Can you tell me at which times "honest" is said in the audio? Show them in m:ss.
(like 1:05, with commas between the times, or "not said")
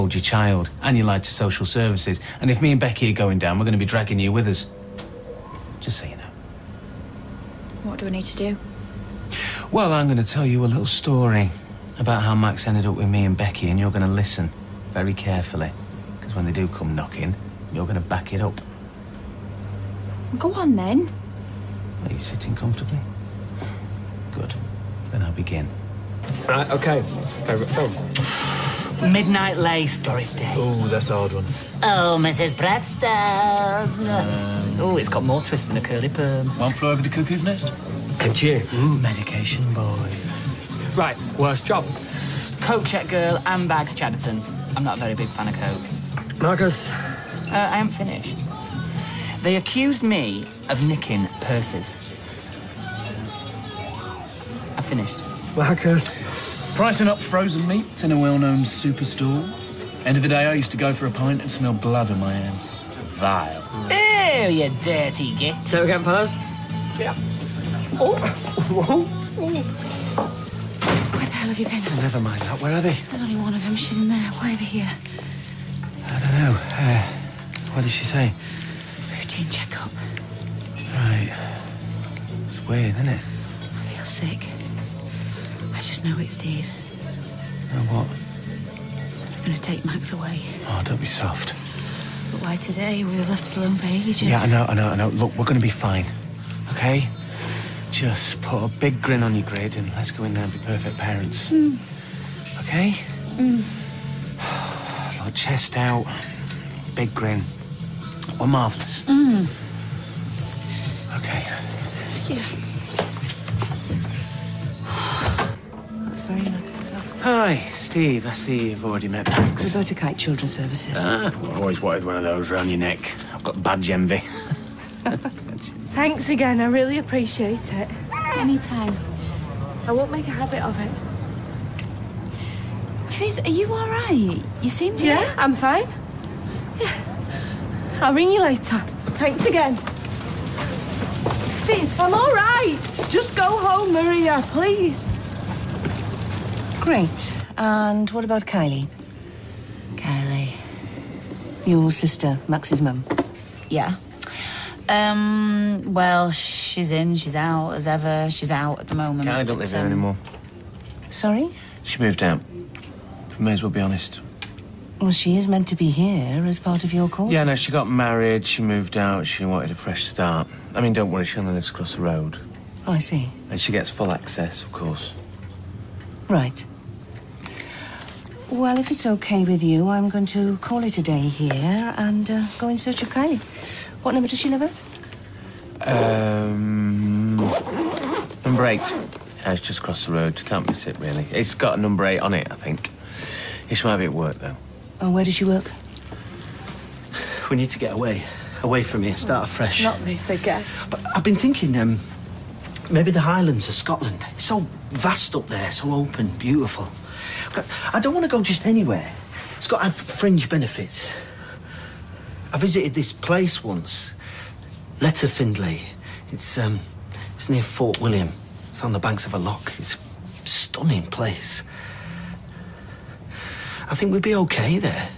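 2:43.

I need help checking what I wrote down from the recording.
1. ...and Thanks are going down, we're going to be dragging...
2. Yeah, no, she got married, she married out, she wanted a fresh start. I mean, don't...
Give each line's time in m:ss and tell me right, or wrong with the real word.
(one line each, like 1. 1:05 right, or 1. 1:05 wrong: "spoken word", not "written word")
1. 0:02 wrong: "Becky", not "Thanks"
2. 2:47 wrong: "moved", not "married".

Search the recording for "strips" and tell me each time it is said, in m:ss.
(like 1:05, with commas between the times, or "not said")
not said.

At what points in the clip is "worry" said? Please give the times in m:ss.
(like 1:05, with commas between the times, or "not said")
2:51.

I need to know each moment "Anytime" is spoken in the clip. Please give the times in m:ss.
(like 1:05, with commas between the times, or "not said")
2:08.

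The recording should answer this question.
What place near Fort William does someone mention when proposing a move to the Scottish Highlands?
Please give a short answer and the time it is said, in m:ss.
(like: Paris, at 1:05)
Letterfinlay, at 3:34.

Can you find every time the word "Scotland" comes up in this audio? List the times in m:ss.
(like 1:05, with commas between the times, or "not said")
3:23.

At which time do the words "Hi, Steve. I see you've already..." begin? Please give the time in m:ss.
1:57.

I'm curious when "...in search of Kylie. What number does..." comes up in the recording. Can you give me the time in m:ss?
3:02.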